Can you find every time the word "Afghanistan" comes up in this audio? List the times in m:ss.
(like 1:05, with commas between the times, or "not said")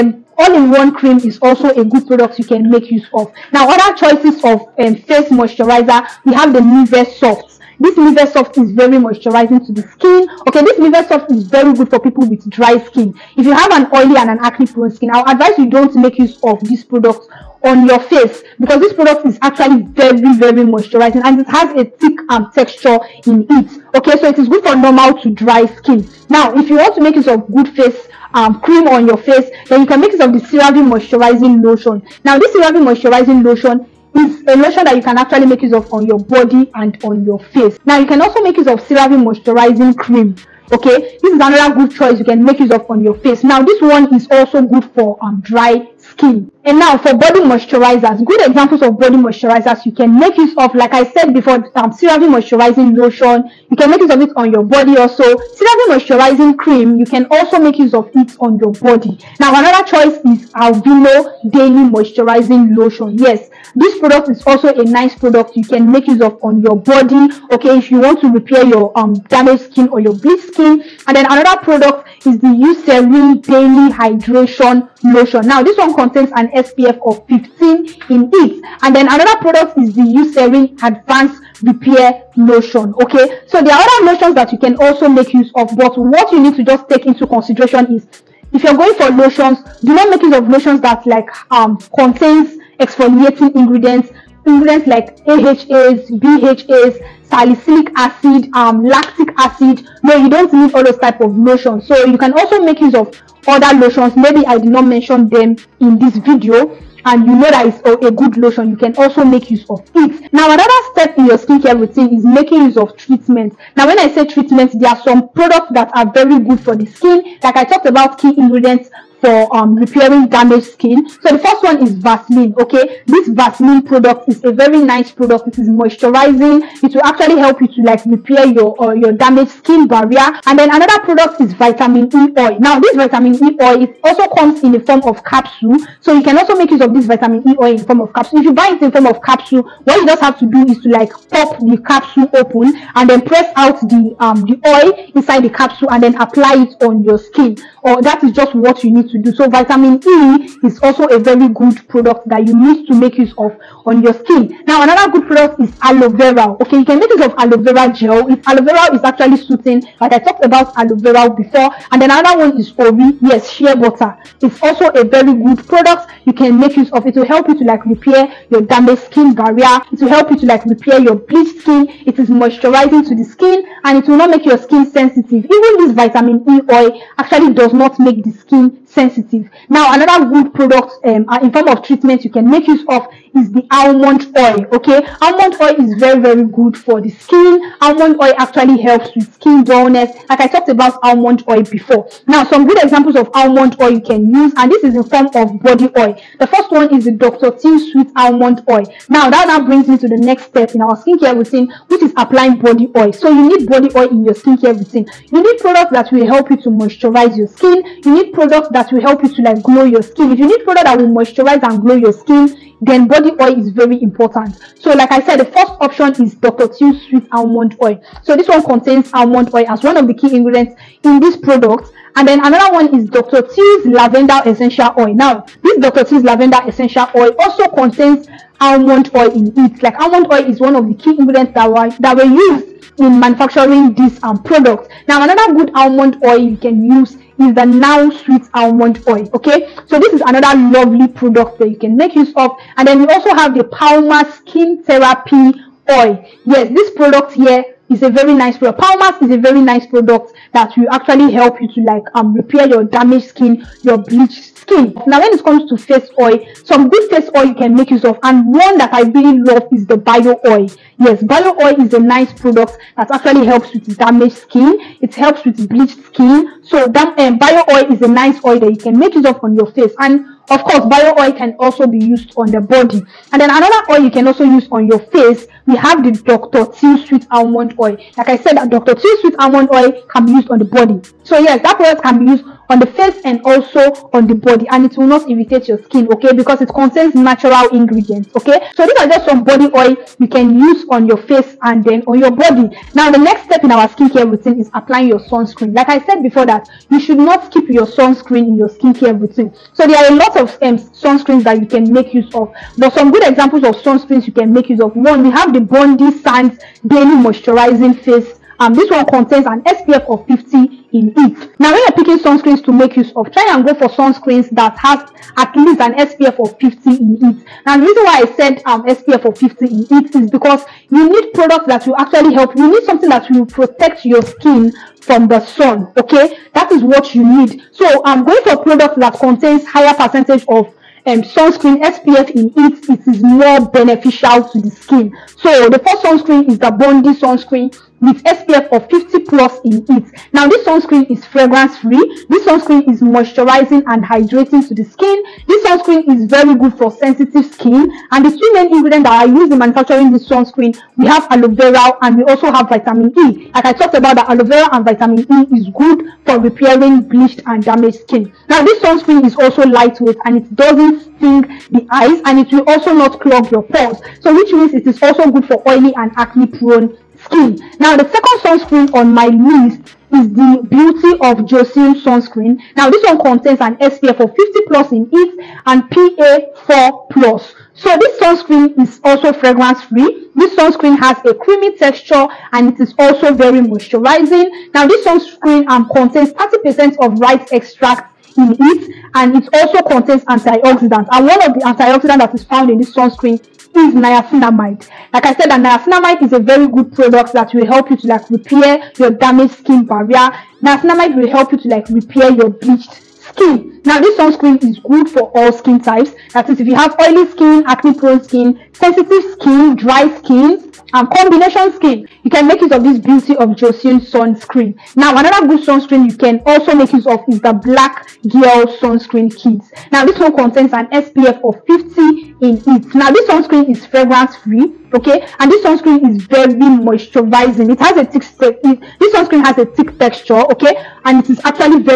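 not said.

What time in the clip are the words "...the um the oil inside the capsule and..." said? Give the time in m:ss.
2:23.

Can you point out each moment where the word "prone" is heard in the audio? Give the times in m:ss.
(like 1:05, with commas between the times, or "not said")
0:14, 6:06, 6:47.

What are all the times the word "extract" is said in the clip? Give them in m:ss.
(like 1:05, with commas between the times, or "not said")
6:27.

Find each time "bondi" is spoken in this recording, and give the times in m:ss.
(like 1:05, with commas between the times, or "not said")
5:05, 5:36.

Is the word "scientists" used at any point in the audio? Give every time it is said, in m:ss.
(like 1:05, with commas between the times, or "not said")
not said.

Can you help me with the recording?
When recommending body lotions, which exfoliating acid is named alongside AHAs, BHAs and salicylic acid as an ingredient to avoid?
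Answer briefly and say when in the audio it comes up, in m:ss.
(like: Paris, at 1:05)
lactic acid, at 1:38.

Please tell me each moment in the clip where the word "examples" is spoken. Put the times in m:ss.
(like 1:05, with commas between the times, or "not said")
0:48, 3:12, 5:03.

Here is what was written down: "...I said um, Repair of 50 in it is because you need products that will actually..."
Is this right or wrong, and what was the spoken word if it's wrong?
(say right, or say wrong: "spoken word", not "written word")
wrong: "SPF", not "Repair".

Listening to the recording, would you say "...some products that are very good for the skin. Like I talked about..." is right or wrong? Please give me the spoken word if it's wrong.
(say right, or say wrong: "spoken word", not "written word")
right.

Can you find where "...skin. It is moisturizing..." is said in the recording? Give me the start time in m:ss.
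2:51.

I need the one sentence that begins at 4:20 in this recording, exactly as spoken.
Yes, bio oil is a nice product that actually helps with damaged skin.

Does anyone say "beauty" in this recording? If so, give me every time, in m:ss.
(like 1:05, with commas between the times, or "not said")
6:10, 6:52.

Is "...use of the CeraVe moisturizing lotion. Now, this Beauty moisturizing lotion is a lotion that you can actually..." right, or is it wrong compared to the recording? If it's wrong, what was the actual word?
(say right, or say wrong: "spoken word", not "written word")
wrong: "CeraVe", not "Beauty".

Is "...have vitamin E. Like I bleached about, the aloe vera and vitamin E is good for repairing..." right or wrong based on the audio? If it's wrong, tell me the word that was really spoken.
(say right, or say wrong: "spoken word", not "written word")
wrong: "talked", not "bleached".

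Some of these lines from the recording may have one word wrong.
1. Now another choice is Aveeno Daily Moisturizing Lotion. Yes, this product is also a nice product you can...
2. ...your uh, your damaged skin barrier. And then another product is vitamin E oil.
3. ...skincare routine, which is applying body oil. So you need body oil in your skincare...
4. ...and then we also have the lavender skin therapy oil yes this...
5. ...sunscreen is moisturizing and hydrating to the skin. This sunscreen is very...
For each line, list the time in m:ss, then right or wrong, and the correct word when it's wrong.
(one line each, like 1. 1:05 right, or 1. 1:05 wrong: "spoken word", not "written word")
1. 0:59 right
2. 2:08 right
3. 3:20 right
4. 4:02 wrong: "palmer", not "lavender"
5. 5:42 right.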